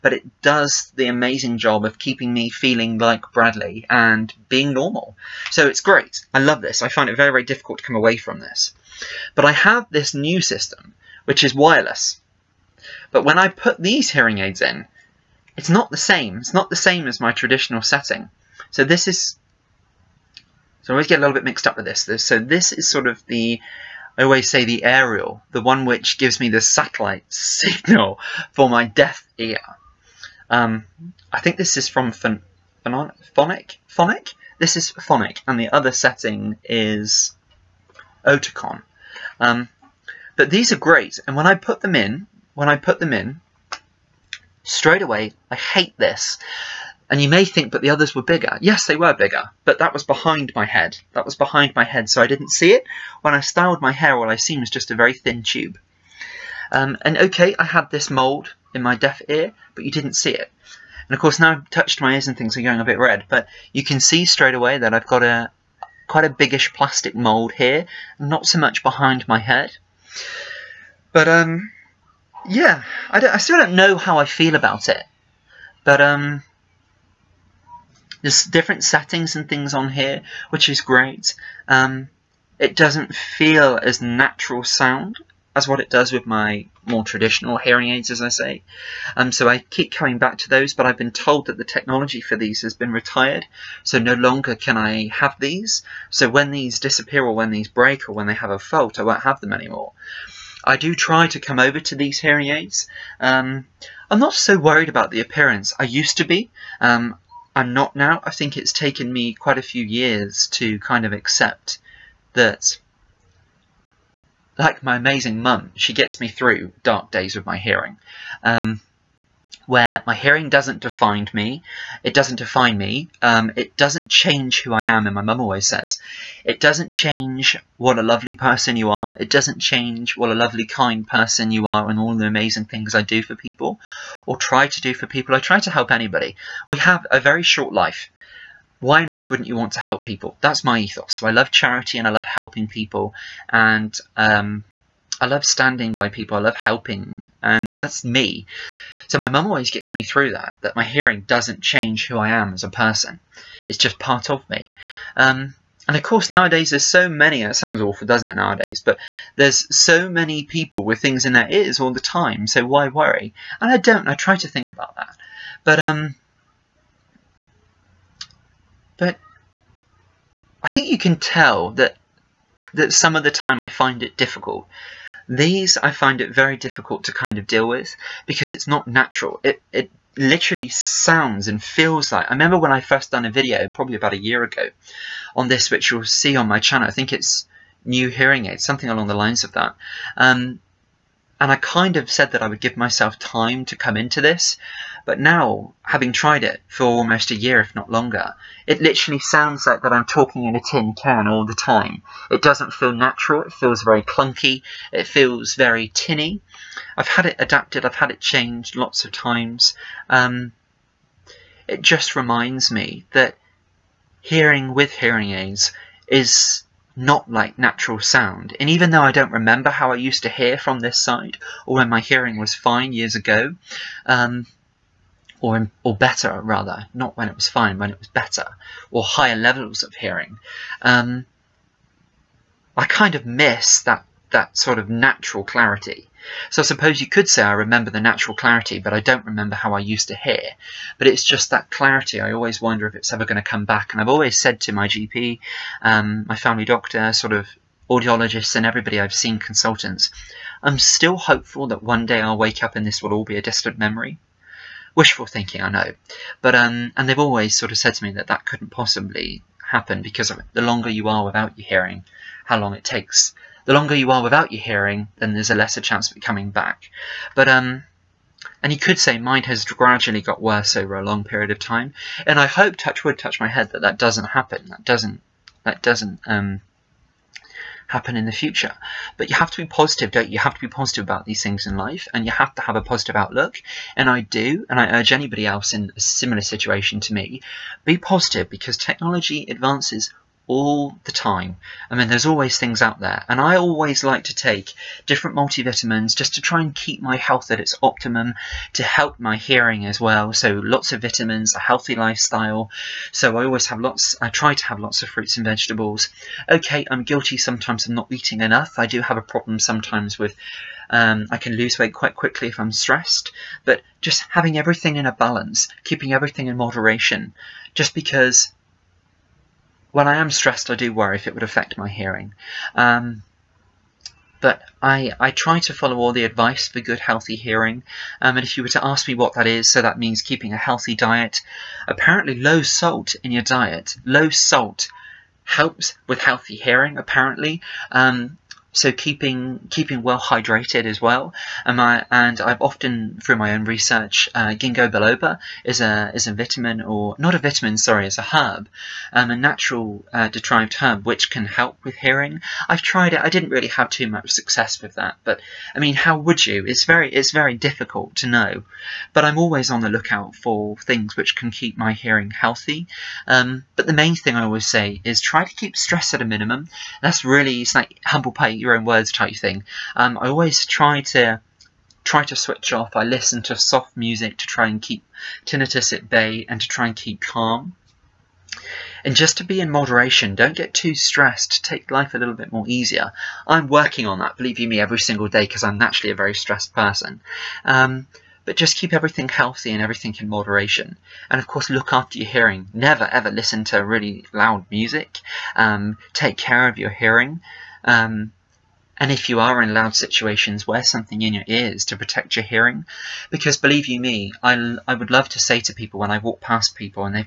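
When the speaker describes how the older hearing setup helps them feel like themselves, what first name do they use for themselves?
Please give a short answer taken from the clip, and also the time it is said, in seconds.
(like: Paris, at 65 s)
Bradley, at 3 s.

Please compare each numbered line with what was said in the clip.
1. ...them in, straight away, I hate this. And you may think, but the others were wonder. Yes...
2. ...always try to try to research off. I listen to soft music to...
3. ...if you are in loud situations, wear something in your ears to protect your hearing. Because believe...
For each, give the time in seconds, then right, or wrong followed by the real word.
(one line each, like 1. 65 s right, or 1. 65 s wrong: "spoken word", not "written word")
1. 42 s wrong: "bigger", not "wonder"
2. 370 s wrong: "switch", not "research"
3. 399 s right.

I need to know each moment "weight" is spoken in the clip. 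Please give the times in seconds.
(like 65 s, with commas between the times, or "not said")
311 s.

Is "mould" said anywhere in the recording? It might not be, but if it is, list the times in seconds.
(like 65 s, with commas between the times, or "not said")
58 s, 67 s.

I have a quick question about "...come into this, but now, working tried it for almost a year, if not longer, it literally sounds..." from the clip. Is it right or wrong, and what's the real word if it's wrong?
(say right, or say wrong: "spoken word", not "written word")
wrong: "having", not "working".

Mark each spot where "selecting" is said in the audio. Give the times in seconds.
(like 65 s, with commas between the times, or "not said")
not said.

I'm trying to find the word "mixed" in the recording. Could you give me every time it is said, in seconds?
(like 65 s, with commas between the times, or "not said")
21 s.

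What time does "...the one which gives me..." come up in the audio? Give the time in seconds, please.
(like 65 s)
25 s.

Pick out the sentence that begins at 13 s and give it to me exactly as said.
But when I put these hearing aids in, it's not the same.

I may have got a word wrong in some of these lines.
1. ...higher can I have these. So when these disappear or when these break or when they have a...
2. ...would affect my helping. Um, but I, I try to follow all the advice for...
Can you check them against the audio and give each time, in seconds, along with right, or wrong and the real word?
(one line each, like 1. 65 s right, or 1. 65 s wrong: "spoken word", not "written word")
1. 94 s wrong: "longer", not "higher"
2. 321 s wrong: "hearing", not "helping".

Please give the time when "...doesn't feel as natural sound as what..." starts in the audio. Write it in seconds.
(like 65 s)
82 s.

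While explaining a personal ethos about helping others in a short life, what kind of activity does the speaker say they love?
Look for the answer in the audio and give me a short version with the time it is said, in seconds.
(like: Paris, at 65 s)
charity, at 141 s.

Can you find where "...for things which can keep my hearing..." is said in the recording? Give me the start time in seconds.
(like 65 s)
360 s.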